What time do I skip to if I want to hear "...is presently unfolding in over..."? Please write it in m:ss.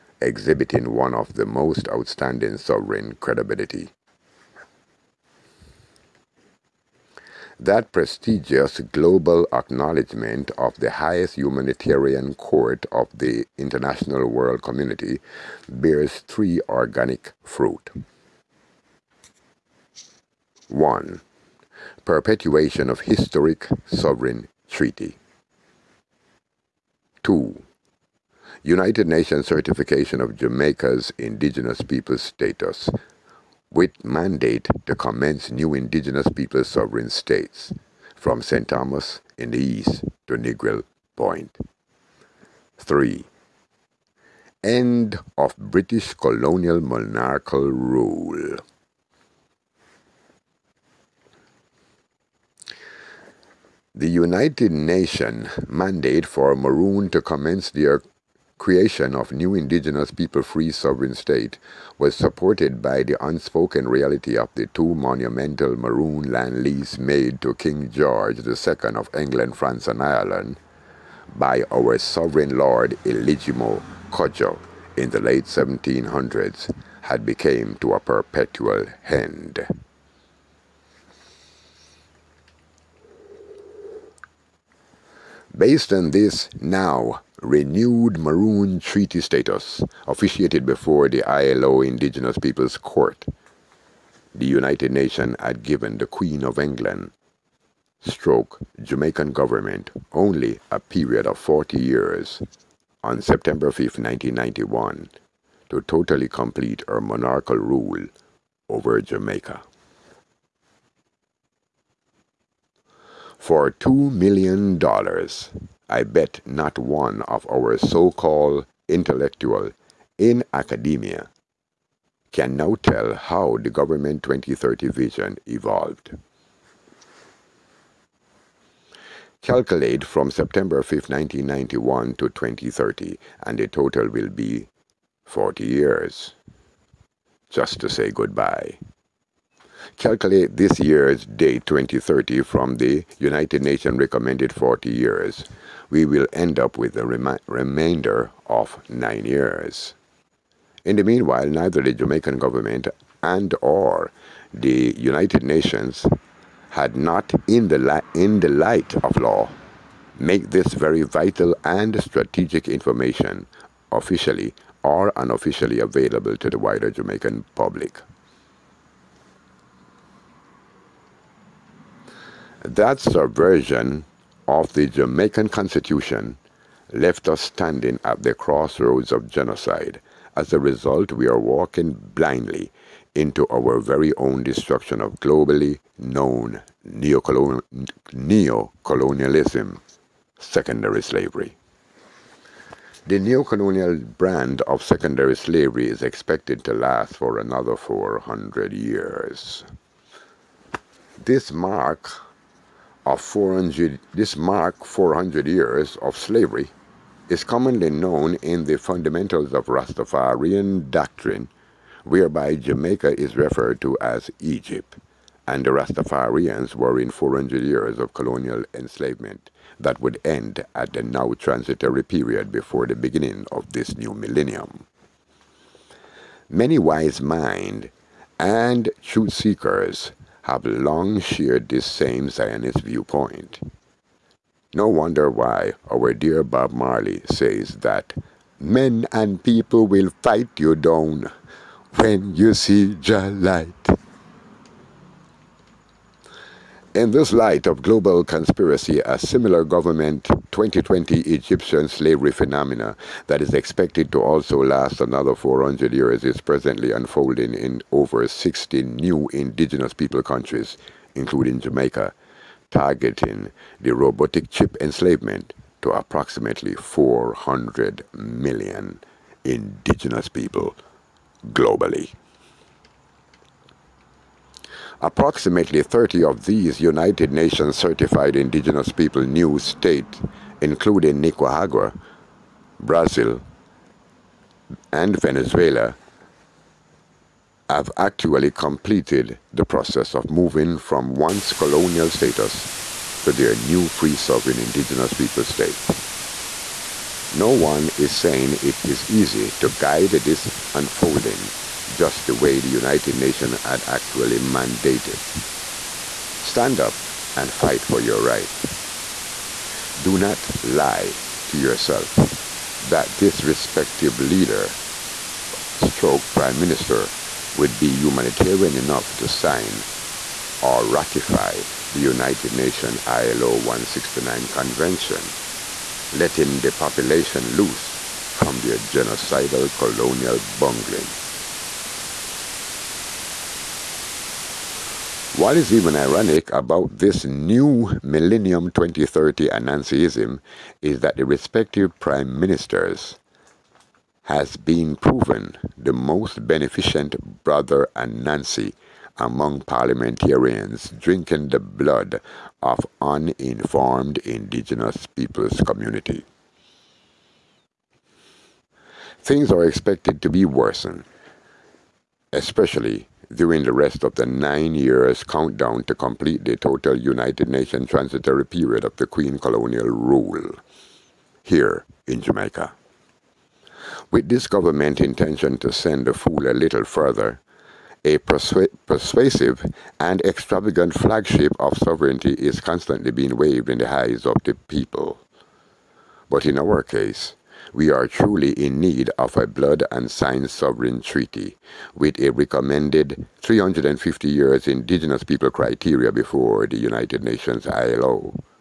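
4:16.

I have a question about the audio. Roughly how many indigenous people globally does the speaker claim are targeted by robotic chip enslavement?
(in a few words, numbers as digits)
400 million.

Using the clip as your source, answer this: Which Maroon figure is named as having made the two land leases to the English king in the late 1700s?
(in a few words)
Eligimo Kojo.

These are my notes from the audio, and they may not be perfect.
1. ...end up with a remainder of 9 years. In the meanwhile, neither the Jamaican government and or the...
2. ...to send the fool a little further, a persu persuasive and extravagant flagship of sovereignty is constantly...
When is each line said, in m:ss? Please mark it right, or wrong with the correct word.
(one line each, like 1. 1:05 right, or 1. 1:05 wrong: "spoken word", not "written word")
1. 2:26 right
2. 6:15 right.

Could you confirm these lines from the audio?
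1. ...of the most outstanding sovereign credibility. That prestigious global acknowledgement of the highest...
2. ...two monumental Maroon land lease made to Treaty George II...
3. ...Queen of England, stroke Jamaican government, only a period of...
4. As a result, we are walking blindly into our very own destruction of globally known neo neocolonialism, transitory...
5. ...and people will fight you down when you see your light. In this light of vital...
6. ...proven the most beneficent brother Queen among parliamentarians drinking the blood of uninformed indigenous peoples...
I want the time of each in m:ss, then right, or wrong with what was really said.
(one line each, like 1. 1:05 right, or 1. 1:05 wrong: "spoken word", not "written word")
1. 0:01 right
2. 1:04 wrong: "King", not "Treaty"
3. 1:36 right
4. 3:00 wrong: "secondary", not "transitory"
5. 3:59 wrong: "global", not "vital"
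6. 5:44 wrong: "Anansi", not "Queen".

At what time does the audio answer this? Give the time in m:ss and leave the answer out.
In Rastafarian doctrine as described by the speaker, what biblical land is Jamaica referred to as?
3:34.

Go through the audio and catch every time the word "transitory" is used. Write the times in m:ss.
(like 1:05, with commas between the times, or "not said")
3:41, 6:07.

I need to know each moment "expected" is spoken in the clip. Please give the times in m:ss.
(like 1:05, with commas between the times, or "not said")
3:16, 4:13, 5:59.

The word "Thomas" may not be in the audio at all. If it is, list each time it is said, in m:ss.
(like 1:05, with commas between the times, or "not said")
0:38.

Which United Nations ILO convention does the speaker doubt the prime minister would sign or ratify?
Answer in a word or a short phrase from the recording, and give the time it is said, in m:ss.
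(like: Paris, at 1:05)
ILO 169, at 5:23.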